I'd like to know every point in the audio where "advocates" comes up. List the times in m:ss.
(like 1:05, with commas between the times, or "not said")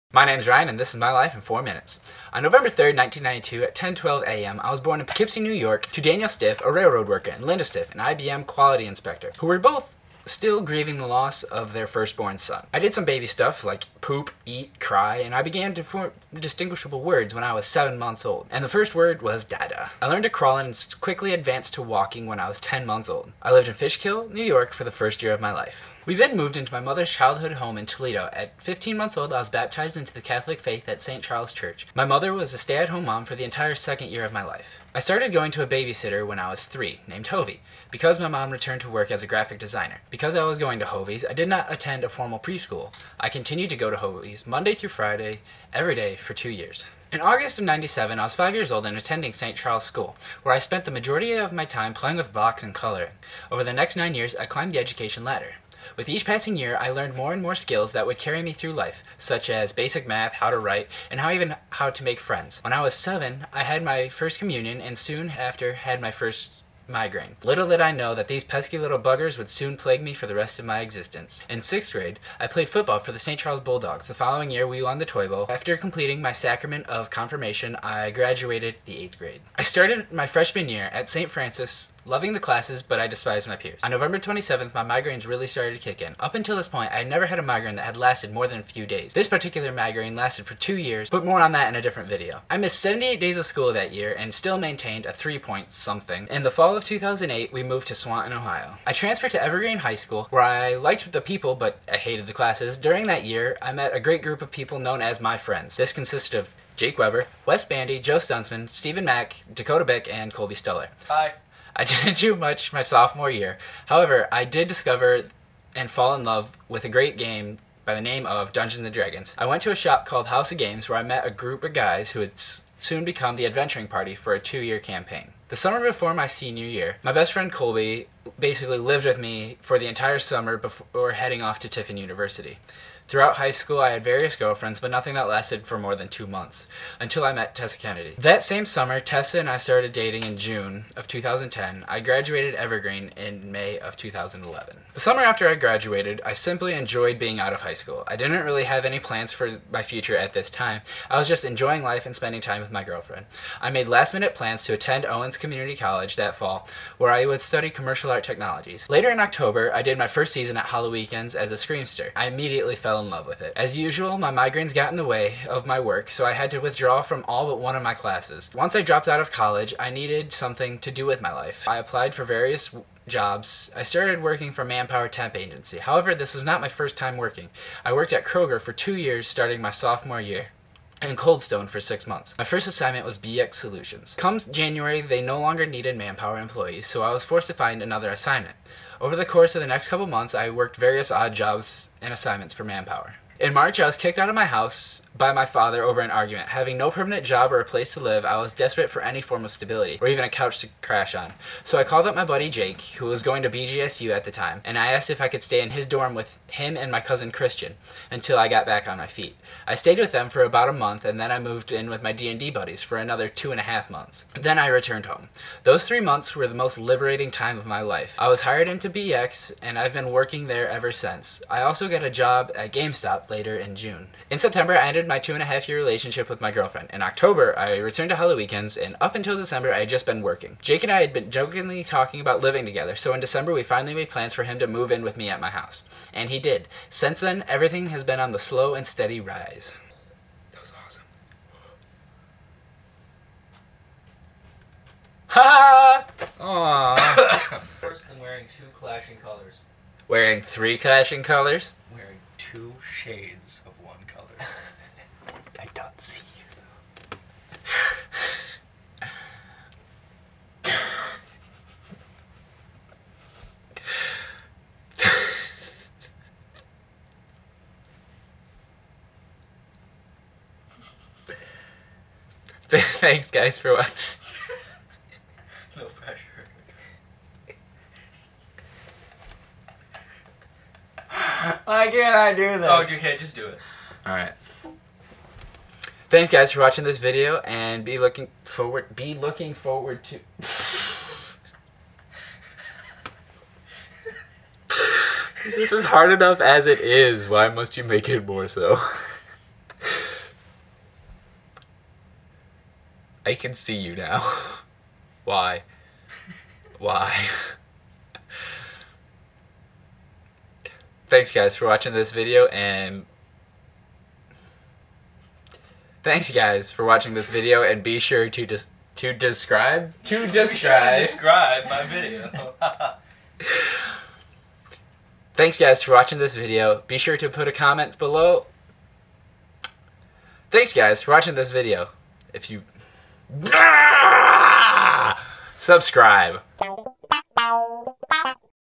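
not said.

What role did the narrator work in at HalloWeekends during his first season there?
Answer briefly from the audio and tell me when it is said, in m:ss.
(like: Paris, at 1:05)
screamster, at 2:41.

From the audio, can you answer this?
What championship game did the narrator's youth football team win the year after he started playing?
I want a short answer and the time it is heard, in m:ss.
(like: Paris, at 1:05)
Toy Bowl, at 1:15.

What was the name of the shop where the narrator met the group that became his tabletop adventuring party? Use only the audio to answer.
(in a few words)
House of Games.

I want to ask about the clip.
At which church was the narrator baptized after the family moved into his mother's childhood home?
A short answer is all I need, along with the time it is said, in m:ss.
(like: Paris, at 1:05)
St. Charles Church, at 0:31.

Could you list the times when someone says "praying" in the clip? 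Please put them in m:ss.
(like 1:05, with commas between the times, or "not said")
not said.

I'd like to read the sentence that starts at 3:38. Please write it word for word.
I was hired into BX, and I've been working there ever since.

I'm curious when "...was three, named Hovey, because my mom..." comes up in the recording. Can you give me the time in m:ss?
0:36.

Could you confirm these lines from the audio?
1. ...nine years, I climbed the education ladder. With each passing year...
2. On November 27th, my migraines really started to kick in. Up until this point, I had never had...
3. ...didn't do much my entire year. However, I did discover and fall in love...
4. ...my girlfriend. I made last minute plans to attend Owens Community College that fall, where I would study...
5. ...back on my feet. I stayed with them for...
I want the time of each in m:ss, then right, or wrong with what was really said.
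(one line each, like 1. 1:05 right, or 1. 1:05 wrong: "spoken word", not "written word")
1. 0:53 right
2. 1:23 right
3. 1:51 wrong: "sophomore", not "entire"
4. 2:32 right
5. 3:28 right.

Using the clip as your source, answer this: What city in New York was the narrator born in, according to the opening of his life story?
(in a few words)
Poughkeepsie.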